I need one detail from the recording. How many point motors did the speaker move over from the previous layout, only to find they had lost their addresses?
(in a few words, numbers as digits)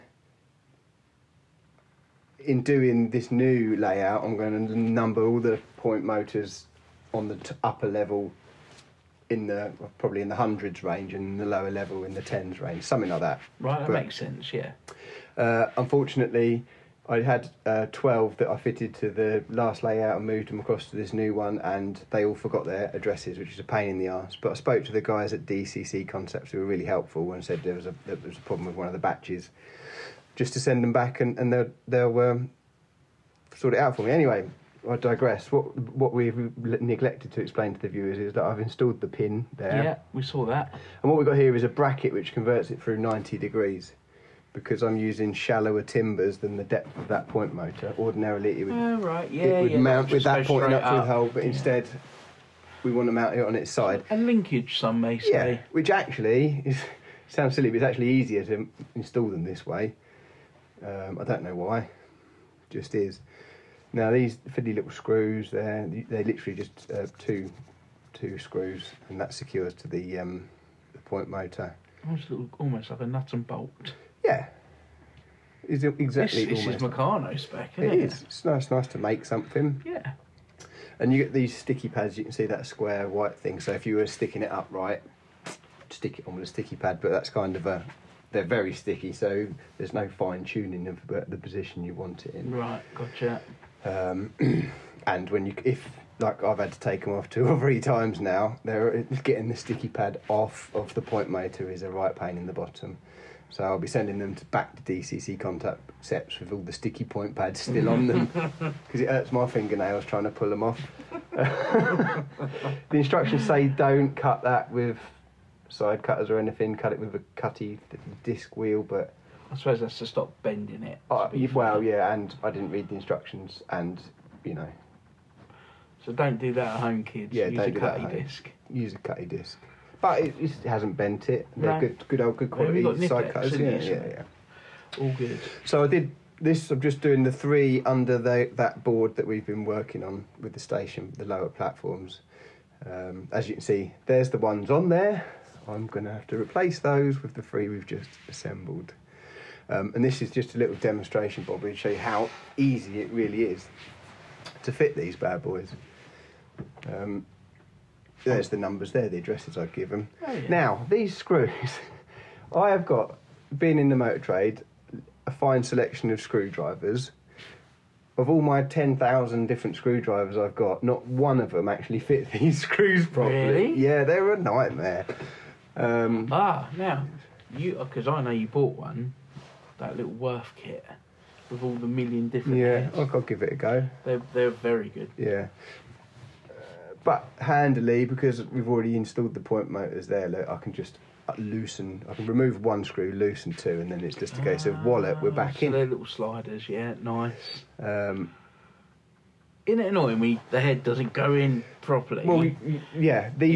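12.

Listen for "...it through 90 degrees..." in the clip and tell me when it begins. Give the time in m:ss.
0:42.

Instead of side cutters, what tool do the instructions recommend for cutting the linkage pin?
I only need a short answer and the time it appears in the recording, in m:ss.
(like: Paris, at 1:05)
Cutty disc wheel, at 1:57.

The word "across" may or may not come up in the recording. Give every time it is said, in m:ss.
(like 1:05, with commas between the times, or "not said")
0:20.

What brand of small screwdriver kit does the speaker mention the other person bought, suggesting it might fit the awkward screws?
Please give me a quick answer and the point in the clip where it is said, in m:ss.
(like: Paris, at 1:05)
Worth, at 3:00.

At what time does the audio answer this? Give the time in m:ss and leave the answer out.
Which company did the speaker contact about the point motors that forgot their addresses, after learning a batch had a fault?
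0:25.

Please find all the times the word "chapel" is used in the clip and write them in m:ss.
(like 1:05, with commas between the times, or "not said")
not said.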